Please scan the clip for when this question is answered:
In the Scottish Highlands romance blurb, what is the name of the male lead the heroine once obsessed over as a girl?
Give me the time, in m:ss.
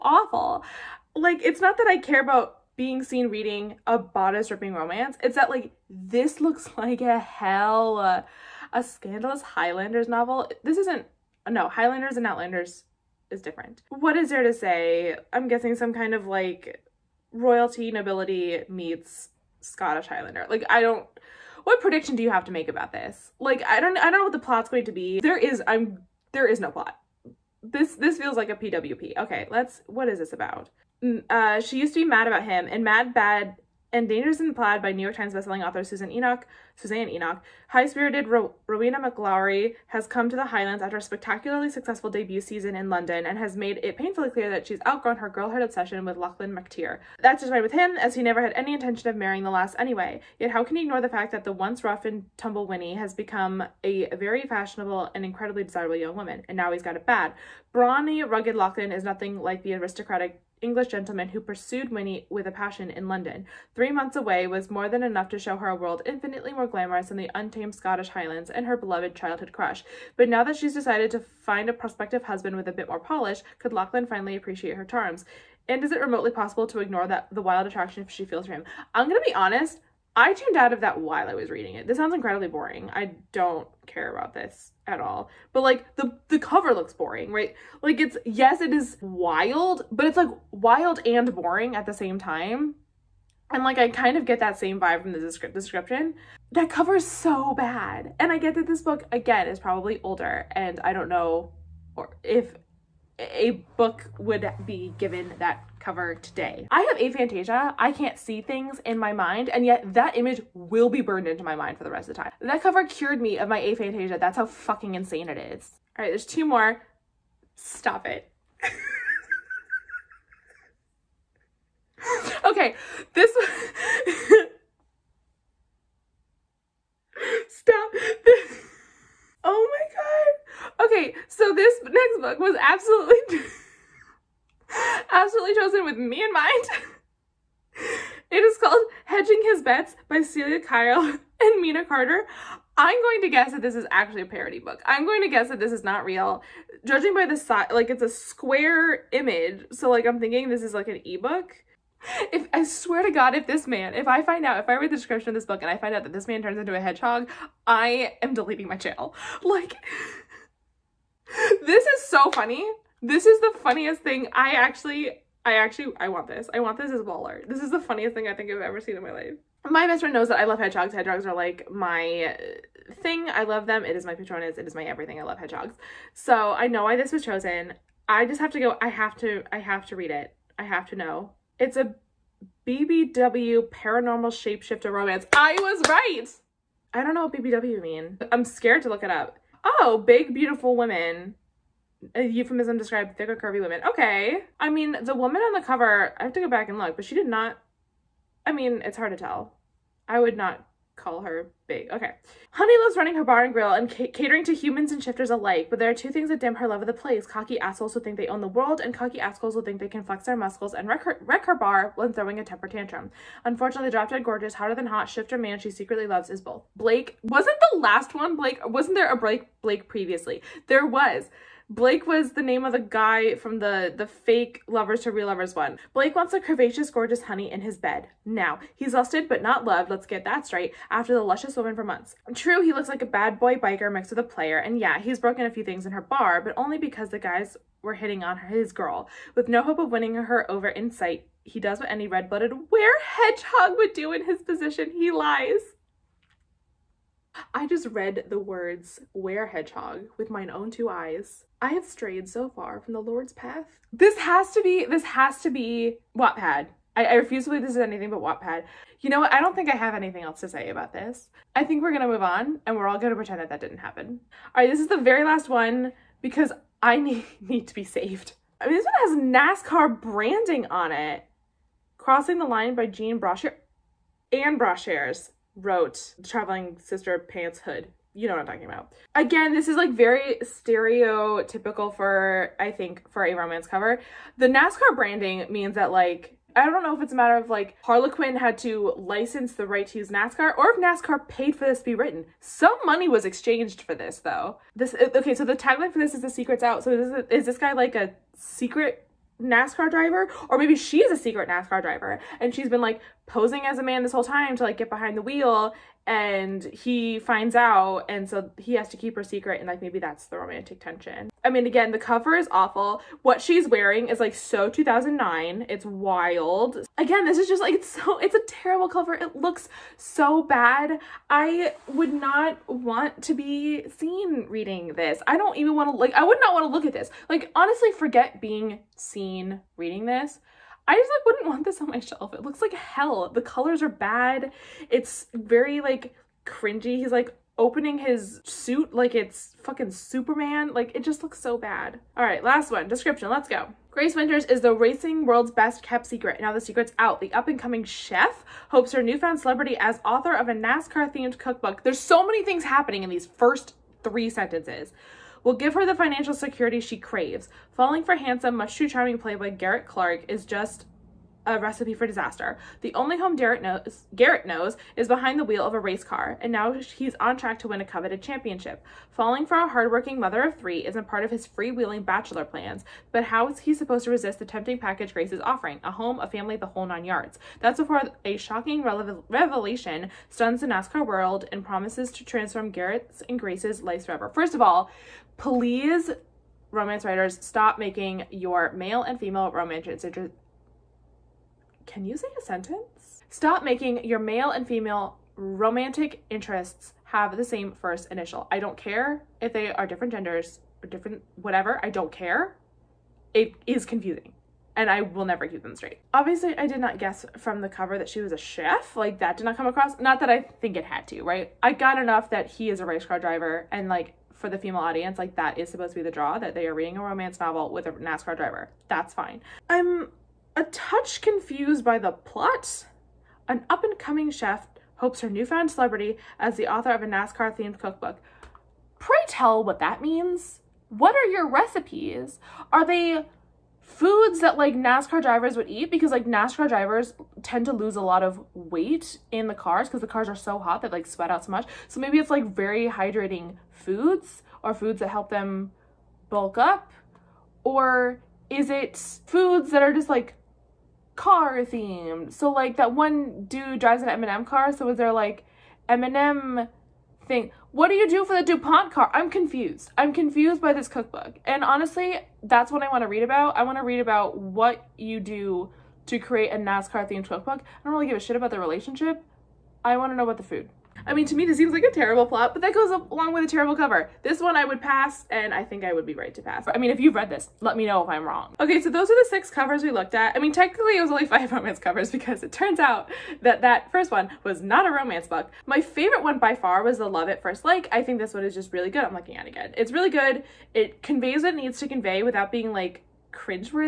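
0:46.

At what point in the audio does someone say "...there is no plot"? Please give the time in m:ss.
0:26.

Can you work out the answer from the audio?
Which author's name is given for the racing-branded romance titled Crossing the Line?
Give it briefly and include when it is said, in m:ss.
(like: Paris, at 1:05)
Jean Brashear, at 4:32.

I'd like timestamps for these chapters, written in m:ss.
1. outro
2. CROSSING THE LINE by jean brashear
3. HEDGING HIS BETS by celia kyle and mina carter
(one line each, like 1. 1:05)
1. 7:58
2. 4:23
3. 1:55.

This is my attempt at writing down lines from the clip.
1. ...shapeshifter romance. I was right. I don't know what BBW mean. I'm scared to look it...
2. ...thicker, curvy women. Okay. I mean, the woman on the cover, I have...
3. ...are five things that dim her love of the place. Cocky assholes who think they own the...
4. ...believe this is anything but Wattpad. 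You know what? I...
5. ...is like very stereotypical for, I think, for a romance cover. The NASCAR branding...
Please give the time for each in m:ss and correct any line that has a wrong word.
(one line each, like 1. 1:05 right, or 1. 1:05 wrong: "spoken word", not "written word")
1. 3:04 right
2. 3:13 right
3. 3:25 wrong: "two", not "five"
4. 4:17 right
5. 4:39 right.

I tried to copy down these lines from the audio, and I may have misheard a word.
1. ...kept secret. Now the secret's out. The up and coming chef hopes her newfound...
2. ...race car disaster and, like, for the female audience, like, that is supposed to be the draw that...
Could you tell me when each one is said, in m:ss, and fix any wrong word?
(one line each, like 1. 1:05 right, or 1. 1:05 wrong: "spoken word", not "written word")
1. 5:45 right
2. 6:52 wrong: "driver", not "disaster".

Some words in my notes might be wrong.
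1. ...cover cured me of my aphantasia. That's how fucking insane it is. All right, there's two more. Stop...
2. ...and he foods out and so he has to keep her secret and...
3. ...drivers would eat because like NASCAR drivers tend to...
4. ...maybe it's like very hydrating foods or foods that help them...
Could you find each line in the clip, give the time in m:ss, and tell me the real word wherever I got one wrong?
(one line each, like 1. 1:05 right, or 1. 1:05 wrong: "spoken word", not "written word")
1. 1:52 right
2. 5:06 wrong: "finds", not "foods"
3. 7:15 right
4. 7:21 right.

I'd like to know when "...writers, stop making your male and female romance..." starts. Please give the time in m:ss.
6:27.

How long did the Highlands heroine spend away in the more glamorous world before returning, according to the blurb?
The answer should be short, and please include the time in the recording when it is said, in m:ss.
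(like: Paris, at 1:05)
Three months, at 1:03.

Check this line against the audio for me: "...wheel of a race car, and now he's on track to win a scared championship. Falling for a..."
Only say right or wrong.
wrong.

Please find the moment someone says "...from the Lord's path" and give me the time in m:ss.
4:12.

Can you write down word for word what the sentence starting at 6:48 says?
Like, that did not come across.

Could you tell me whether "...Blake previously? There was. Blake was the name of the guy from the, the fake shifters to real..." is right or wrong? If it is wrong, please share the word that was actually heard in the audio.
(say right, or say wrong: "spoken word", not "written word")
wrong: "lovers", not "shifters".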